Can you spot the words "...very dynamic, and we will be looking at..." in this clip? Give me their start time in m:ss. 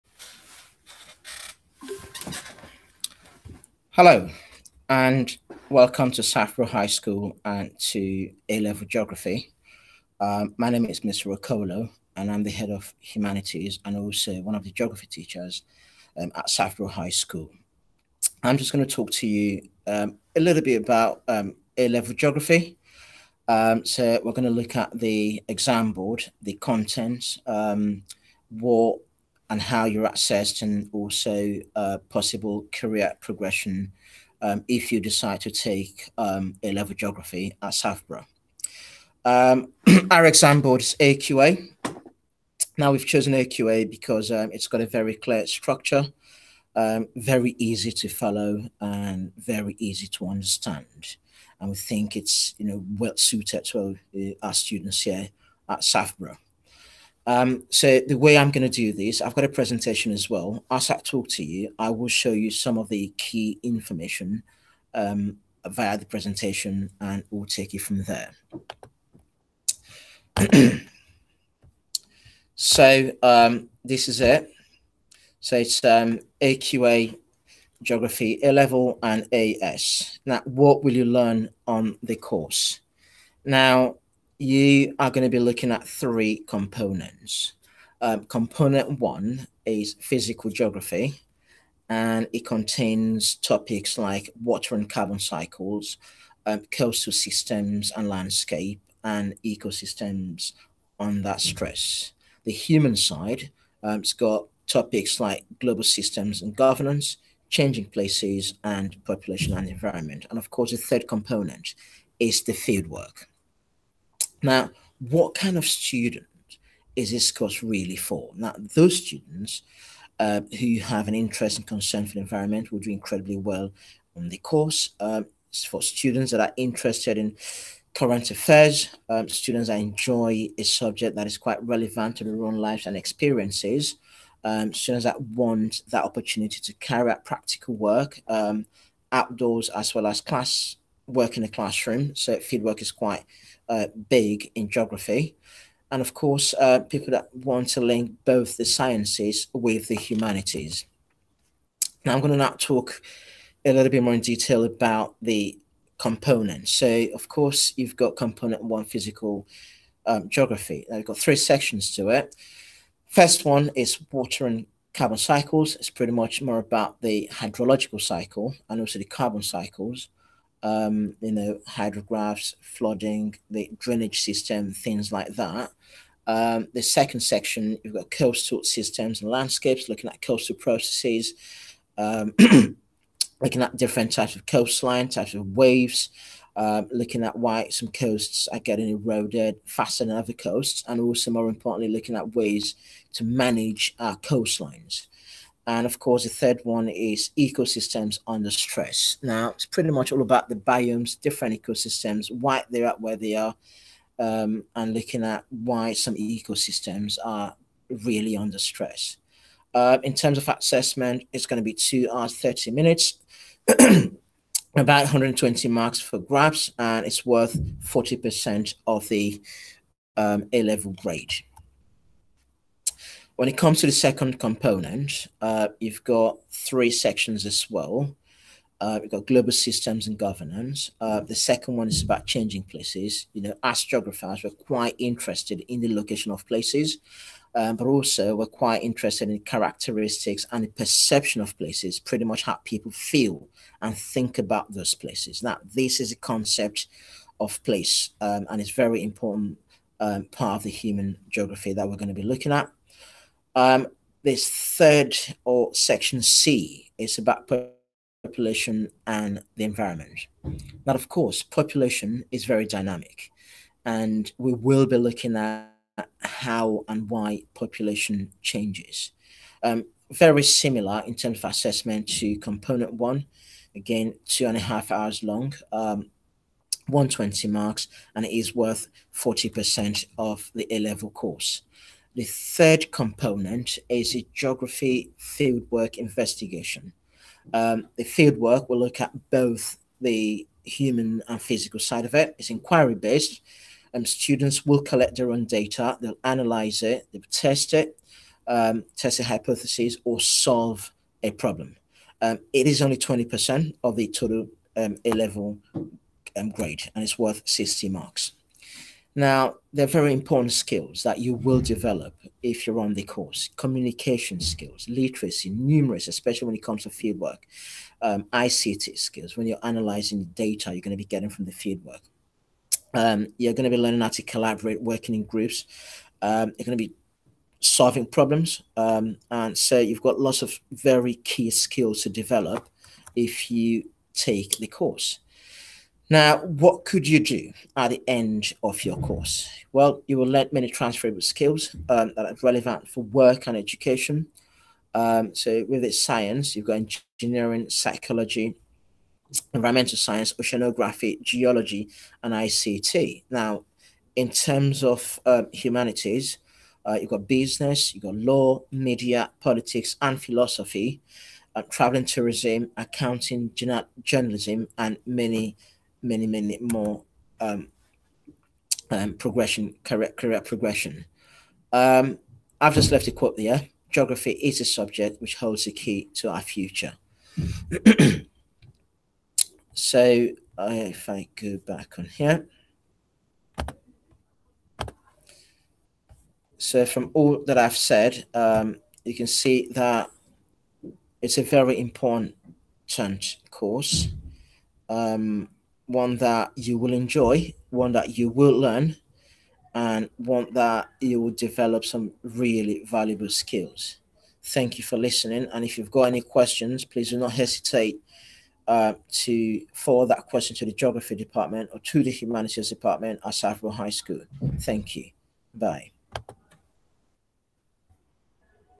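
4:22.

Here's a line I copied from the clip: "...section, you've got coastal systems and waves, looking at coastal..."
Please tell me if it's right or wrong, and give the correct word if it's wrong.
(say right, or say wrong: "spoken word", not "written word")
wrong: "landscapes", not "waves".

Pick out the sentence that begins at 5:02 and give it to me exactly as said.
Um, it is only 20% of the total um, A level um, grade, and it's worth 60 marks.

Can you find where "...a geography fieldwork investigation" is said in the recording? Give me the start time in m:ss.
4:44.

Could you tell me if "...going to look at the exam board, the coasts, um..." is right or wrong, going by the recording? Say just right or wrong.
wrong.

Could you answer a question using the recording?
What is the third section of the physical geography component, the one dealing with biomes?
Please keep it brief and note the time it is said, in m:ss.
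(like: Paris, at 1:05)
Ecosystems under stress, at 3:17.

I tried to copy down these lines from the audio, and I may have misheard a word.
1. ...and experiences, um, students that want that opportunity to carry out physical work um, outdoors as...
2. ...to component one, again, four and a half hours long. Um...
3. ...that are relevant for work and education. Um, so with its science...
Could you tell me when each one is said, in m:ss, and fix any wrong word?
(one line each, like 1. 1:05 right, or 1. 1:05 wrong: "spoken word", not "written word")
1. 2:12 wrong: "practical", not "physical"
2. 4:32 wrong: "two", not "four"
3. 5:42 right.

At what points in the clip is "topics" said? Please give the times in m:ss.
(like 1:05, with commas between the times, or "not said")
1:33, 1:44.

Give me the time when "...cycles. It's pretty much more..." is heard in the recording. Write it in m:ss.
2:45.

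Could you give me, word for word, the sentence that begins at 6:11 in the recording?
Um, I've just left a quote there.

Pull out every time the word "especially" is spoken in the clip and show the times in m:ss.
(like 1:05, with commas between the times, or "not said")
5:16.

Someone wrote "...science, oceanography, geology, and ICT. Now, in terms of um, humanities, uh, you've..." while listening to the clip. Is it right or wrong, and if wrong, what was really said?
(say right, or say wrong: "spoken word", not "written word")
right.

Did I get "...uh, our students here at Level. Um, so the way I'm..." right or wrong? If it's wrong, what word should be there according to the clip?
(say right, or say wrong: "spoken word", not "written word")
wrong: "Southborough", not "Level".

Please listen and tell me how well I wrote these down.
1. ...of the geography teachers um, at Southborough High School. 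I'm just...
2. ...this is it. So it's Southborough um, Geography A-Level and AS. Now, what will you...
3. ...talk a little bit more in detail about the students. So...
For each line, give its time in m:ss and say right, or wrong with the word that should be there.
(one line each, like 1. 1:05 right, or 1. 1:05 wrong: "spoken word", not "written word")
1. 0:14 right
2. 1:13 wrong: "AQA", not "Southborough"
3. 2:32 wrong: "components", not "students".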